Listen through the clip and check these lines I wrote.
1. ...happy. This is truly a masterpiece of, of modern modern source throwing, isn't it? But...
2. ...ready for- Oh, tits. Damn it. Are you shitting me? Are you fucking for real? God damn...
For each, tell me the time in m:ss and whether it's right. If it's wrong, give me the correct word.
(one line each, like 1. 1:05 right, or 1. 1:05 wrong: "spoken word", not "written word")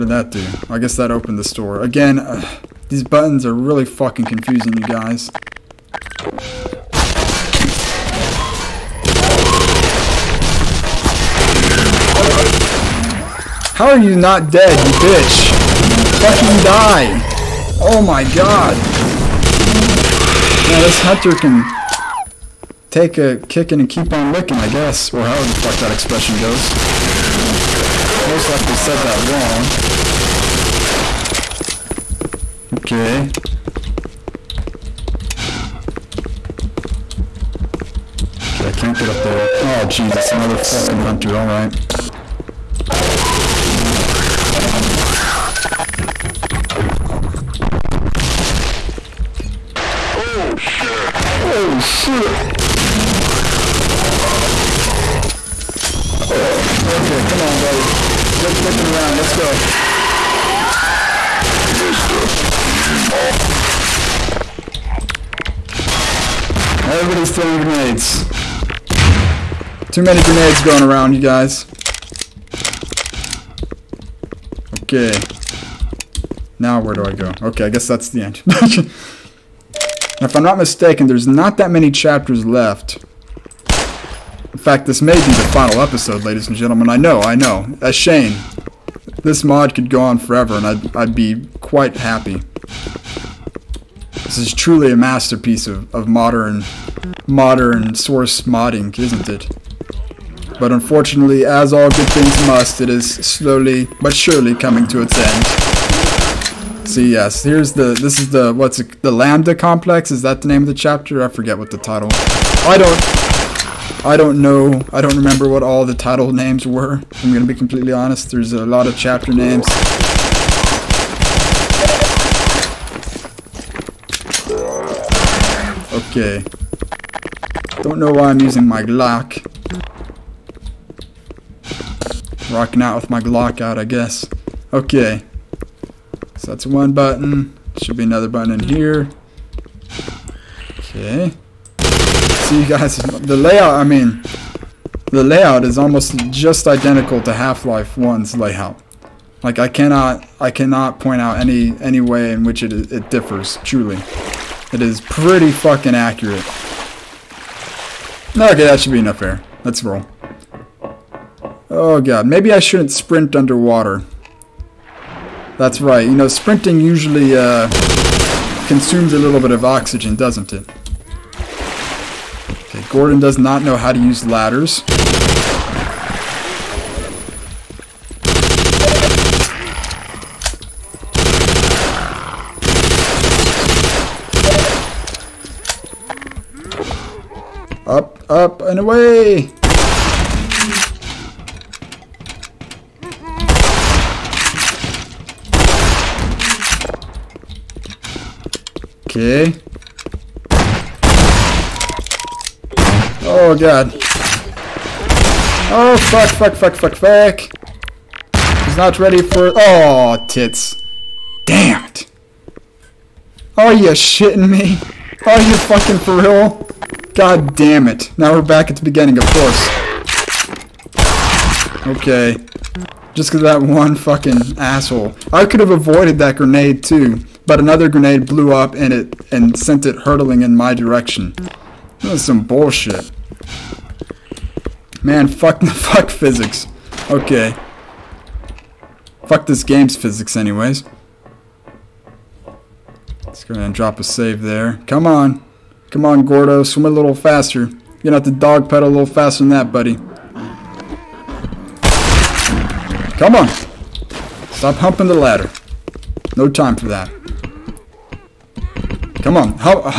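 1. 1:31 wrong: "modding", not "throwing"
2. 3:28 right.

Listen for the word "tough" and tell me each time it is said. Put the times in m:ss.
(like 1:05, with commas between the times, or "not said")
not said.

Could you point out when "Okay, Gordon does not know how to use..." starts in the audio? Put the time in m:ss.
2:52.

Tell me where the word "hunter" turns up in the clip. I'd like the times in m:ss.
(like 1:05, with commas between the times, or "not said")
0:20, 0:40.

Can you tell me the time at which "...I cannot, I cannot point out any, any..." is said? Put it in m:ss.
2:29.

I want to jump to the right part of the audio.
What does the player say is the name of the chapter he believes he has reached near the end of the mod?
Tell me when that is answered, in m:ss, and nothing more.
1:49.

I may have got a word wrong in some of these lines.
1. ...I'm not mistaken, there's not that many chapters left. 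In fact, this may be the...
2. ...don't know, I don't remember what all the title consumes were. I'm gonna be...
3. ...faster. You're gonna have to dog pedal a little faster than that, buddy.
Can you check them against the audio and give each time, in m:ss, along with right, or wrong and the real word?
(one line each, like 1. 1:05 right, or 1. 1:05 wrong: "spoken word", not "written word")
1. 1:20 right
2. 1:54 wrong: "names", not "consumes"
3. 4:07 right.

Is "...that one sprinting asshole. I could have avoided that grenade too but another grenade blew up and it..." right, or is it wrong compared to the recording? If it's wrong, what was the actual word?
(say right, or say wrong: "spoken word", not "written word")
wrong: "fucking", not "sprinting".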